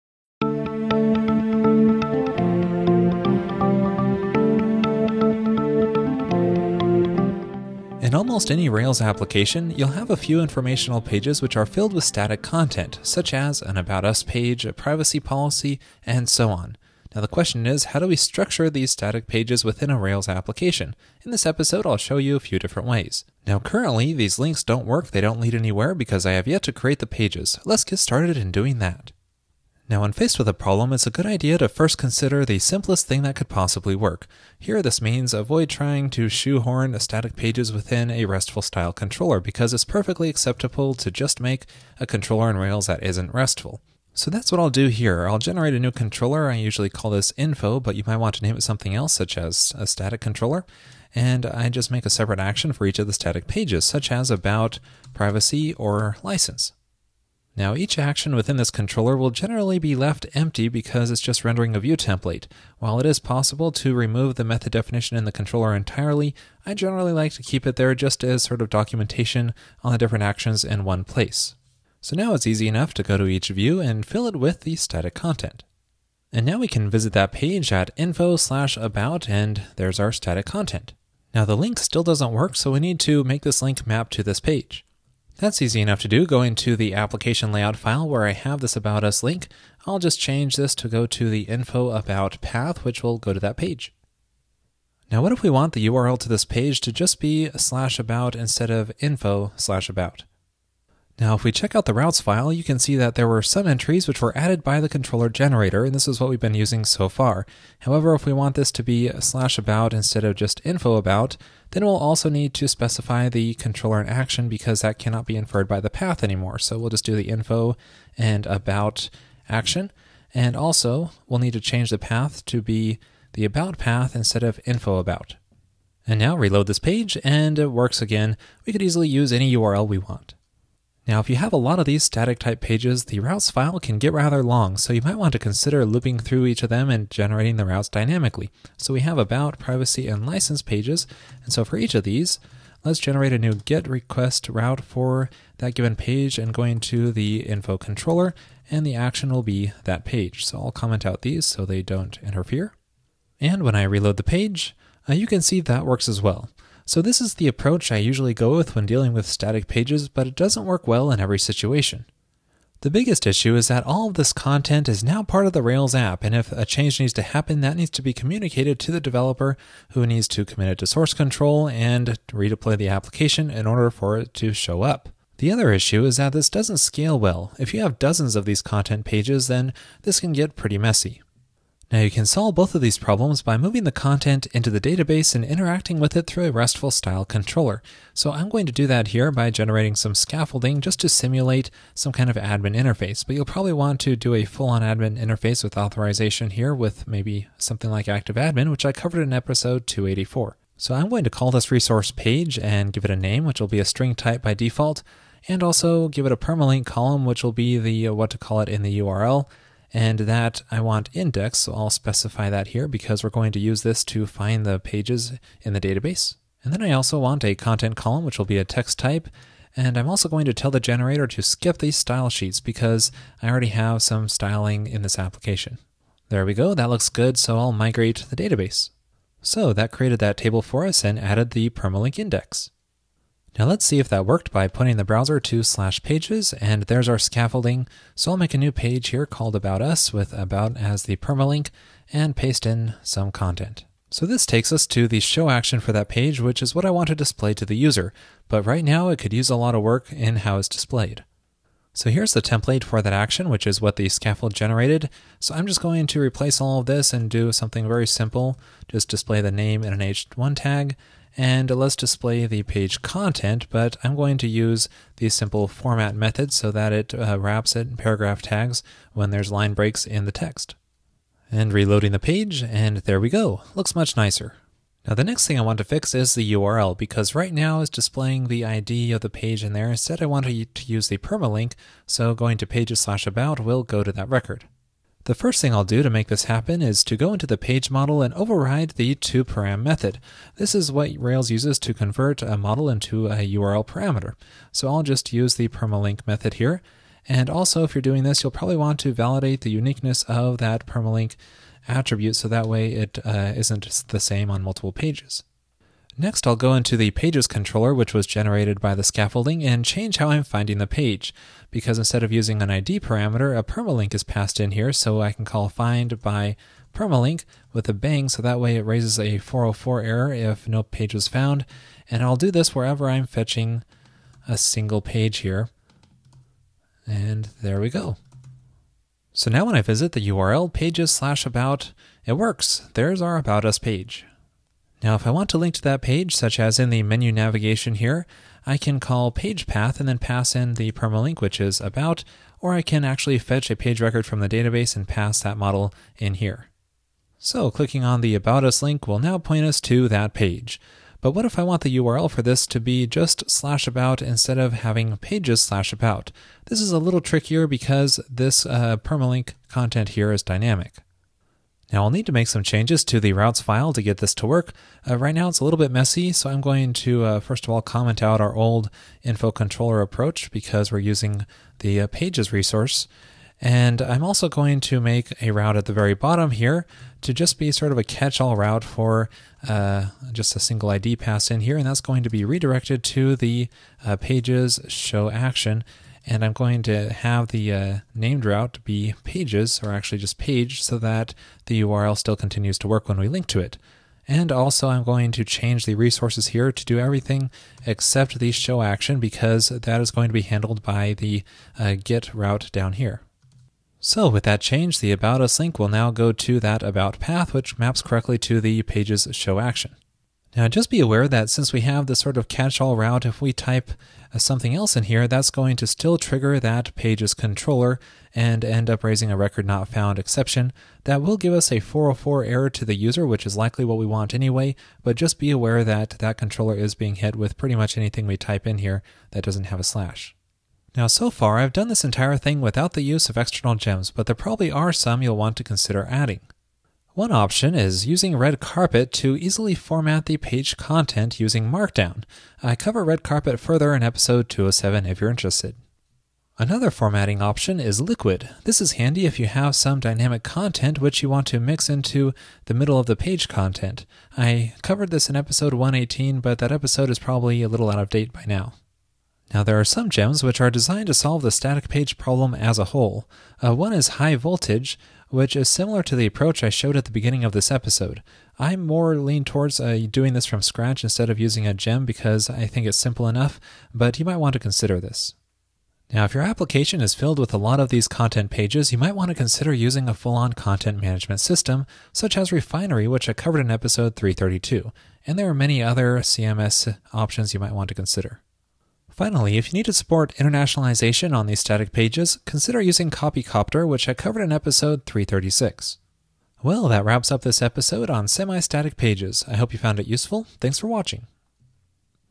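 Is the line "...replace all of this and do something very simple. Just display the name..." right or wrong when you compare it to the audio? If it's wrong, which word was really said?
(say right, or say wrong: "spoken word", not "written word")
right.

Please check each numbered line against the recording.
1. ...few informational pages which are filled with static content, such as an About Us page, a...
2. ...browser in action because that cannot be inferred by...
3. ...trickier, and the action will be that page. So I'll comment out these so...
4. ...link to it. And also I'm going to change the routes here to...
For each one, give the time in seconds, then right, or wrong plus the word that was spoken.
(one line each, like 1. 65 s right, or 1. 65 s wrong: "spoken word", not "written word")
1. 10 s right
2. 113 s wrong: "controller", not "browser"
3. 147 s wrong: "controller", not "trickier"
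4. 393 s wrong: "resources", not "routes".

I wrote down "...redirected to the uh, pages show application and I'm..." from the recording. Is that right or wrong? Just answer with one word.
wrong.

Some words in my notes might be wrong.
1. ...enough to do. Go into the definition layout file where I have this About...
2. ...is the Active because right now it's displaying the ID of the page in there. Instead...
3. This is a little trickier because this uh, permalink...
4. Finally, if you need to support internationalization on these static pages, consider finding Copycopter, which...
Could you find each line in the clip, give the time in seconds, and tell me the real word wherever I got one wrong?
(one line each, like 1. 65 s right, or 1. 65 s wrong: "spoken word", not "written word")
1. 85 s wrong: "application", not "definition"
2. 276 s wrong: "URL", not "Active"
3. 356 s right
4. 489 s wrong: "using", not "finding".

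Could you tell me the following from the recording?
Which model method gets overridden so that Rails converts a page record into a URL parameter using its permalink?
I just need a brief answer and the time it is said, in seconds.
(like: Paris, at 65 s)
toParam, at 289 s.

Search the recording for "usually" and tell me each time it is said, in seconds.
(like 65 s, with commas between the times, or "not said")
46 s, 157 s.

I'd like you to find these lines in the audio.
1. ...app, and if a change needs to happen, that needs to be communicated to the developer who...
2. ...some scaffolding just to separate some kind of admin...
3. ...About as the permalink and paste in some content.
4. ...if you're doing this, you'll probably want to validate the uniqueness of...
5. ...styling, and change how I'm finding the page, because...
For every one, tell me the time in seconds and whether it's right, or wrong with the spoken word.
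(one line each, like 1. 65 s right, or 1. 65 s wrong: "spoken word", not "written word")
1. 165 s right
2. 189 s wrong: "simulate", not "separate"
3. 240 s right
4. 297 s right
5. 309 s wrong: "scaffolding", not "styling".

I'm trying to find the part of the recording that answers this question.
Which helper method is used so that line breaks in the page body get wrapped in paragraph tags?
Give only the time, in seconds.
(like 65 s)
265 s.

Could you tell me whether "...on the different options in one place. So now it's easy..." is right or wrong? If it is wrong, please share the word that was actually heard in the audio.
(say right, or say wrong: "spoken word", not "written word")
wrong: "actions", not "options".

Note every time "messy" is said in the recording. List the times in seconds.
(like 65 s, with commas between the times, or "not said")
180 s, 365 s.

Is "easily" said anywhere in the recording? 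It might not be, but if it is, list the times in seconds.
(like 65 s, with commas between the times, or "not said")
128 s, 439 s.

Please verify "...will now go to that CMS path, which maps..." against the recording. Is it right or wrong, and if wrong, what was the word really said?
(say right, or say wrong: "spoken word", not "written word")
wrong: "About", not "CMS".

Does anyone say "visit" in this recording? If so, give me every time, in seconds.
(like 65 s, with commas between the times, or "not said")
76 s, 329 s.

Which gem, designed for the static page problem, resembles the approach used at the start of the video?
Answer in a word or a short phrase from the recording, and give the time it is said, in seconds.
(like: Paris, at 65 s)
high voltage, at 464 s.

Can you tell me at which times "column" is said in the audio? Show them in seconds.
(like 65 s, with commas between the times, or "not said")
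206 s, 217 s.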